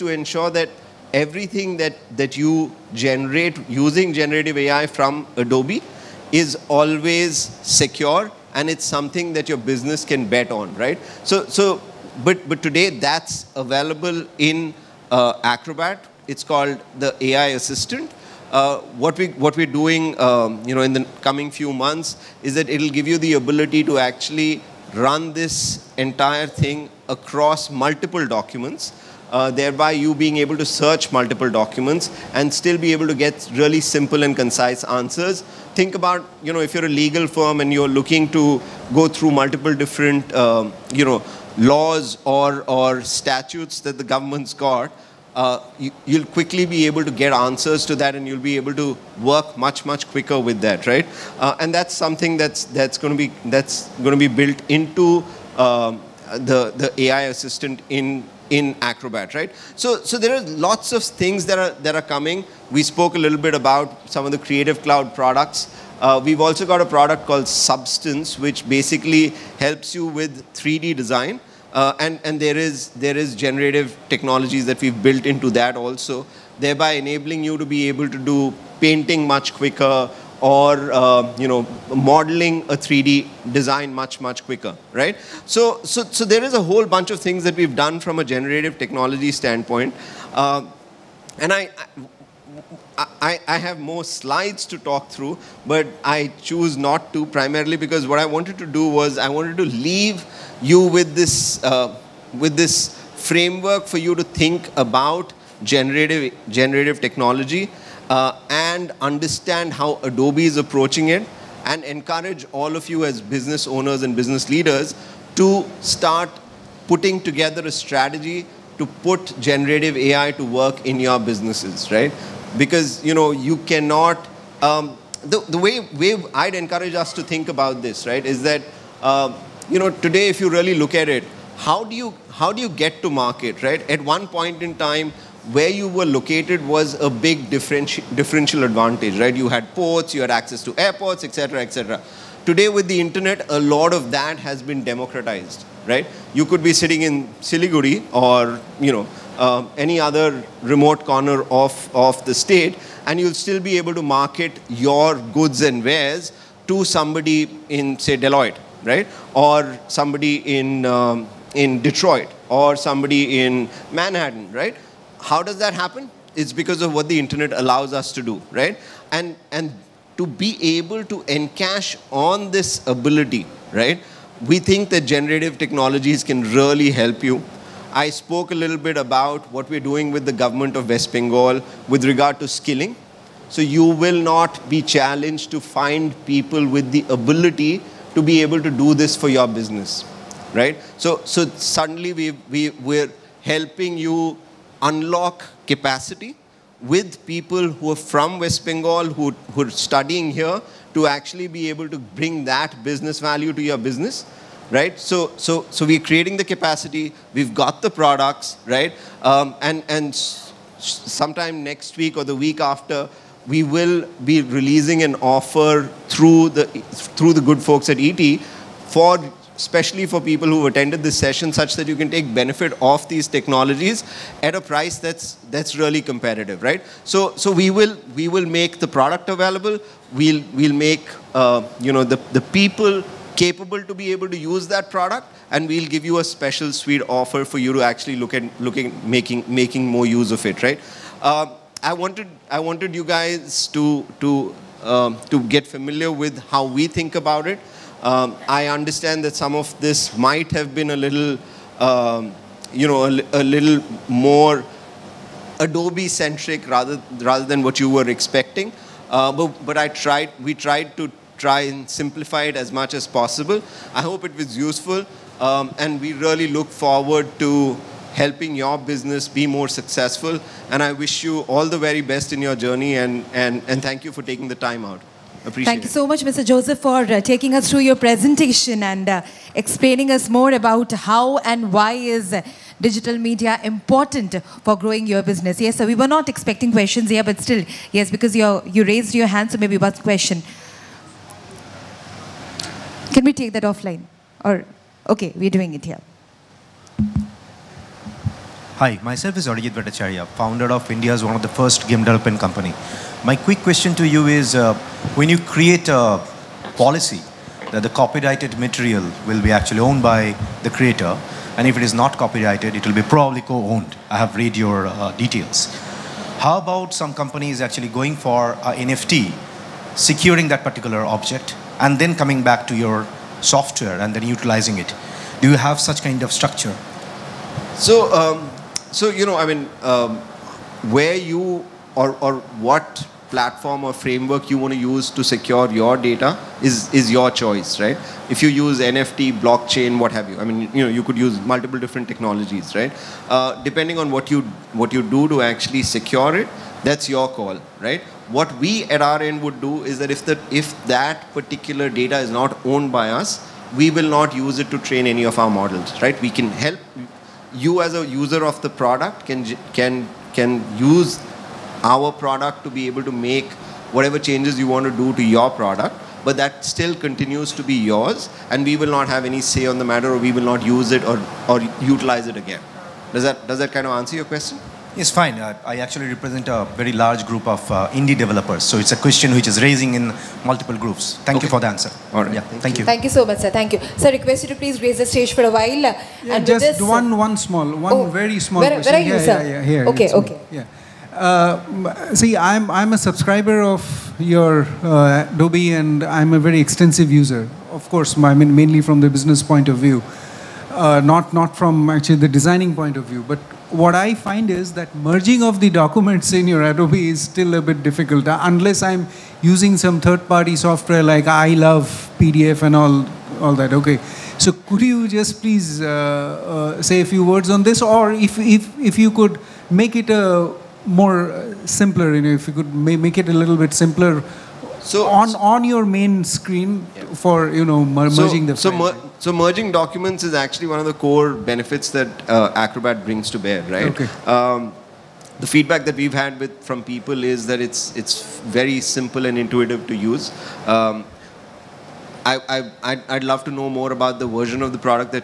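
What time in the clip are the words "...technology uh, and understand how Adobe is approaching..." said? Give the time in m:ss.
1:46.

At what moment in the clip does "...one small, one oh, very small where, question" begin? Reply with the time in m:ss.
6:27.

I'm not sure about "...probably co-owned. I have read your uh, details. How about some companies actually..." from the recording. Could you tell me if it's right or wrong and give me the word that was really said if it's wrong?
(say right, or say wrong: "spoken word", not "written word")
right.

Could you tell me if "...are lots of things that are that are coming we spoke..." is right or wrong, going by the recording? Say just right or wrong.
right.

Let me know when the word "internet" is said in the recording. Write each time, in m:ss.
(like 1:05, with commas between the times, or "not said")
2:22, 2:47.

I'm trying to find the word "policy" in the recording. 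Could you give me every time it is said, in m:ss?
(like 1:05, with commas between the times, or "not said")
5:06.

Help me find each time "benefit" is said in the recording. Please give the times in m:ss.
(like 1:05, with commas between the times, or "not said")
3:42, 7:11.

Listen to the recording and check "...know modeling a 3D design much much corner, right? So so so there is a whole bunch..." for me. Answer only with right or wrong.
wrong.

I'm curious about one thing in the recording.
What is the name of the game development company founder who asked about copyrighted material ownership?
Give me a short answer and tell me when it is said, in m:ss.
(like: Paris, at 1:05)
Arijit Bhattacharya, at 4:59.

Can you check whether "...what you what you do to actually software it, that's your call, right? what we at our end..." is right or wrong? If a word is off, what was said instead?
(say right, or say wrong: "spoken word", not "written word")
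wrong: "secure", not "software".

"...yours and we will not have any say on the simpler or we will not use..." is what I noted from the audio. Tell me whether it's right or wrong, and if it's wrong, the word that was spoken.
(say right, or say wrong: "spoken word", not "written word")
wrong: "matter", not "simpler".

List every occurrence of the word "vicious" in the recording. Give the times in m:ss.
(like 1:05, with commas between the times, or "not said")
not said.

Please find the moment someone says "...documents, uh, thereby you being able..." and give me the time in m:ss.
0:28.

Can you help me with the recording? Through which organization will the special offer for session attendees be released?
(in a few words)
ET.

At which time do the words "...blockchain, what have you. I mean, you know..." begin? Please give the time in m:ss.
5:39.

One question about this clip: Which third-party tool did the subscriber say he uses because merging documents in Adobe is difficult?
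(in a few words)
I love PDF.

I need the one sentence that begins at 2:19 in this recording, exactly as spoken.
You had ports, you had access to airports, etc., etc.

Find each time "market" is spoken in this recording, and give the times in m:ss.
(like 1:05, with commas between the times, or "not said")
2:13, 2:34.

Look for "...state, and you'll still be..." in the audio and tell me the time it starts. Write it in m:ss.
2:32.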